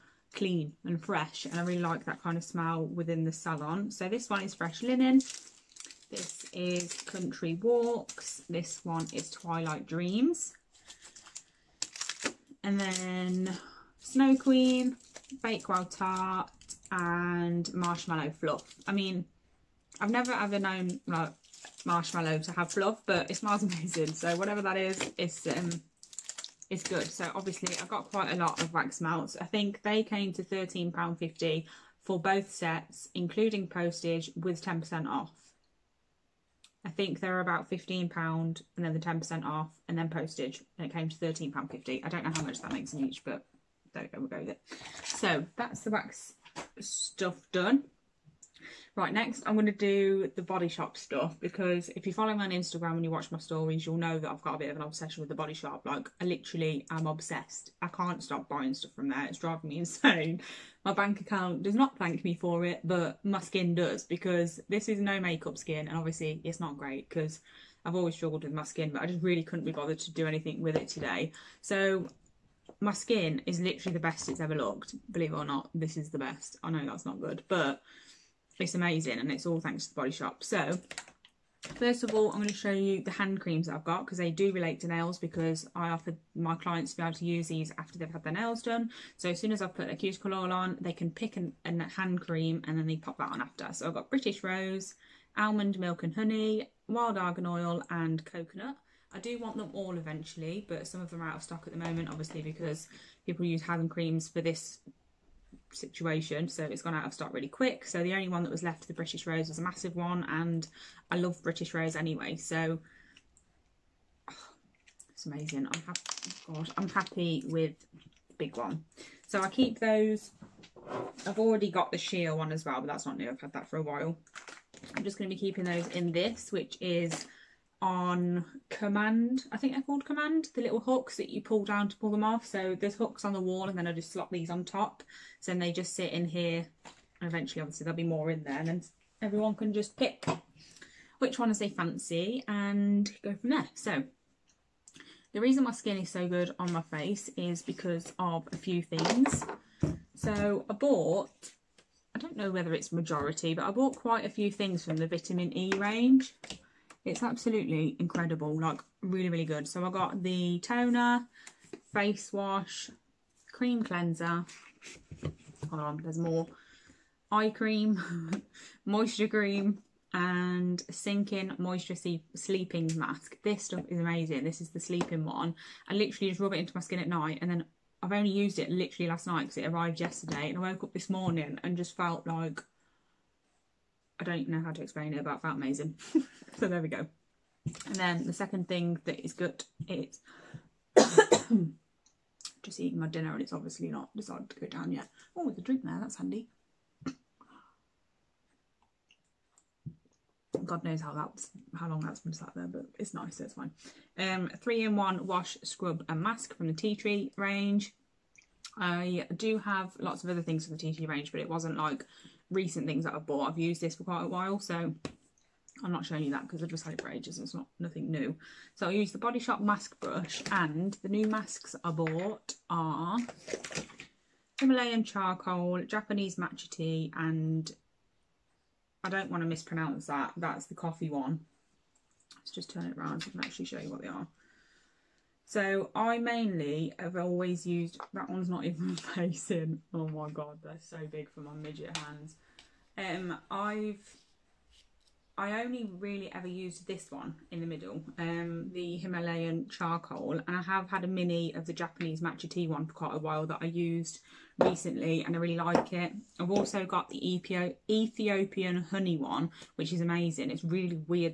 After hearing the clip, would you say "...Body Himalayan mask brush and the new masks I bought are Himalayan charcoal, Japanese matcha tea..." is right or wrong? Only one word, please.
wrong.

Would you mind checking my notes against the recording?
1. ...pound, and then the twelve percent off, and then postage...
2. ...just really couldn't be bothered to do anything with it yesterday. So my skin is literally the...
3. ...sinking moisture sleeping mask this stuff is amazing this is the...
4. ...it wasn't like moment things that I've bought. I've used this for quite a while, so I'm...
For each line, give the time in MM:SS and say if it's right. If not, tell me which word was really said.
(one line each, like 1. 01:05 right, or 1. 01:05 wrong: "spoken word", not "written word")
1. 00:38 wrong: "ten", not "twelve"
2. 01:09 wrong: "today", not "yesterday"
3. 02:50 right
4. 03:31 wrong: "recent", not "moment".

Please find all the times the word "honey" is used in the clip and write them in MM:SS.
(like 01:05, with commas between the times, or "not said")
01:36, 04:18.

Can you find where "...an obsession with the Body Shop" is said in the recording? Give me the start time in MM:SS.
00:54.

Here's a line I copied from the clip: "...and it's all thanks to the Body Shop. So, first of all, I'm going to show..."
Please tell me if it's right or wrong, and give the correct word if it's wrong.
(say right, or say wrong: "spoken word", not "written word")
right.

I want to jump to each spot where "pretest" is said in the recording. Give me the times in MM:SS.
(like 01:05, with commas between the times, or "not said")
not said.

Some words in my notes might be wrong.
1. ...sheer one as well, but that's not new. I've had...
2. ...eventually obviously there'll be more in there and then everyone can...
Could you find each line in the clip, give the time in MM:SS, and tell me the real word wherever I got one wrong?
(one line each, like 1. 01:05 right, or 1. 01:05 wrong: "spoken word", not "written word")
1. 02:01 right
2. 02:17 right.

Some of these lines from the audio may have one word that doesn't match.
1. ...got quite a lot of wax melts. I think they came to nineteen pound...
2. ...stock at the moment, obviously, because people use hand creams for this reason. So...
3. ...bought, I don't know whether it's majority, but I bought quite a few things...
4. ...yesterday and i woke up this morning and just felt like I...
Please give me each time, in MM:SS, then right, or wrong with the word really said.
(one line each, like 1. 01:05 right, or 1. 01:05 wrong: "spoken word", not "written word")
1. 00:27 wrong: "thirteen", not "nineteen"
2. 01:41 wrong: "situation", not "reason"
3. 02:30 right
4. 02:59 right.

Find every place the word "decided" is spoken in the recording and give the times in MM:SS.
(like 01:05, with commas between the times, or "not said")
03:14.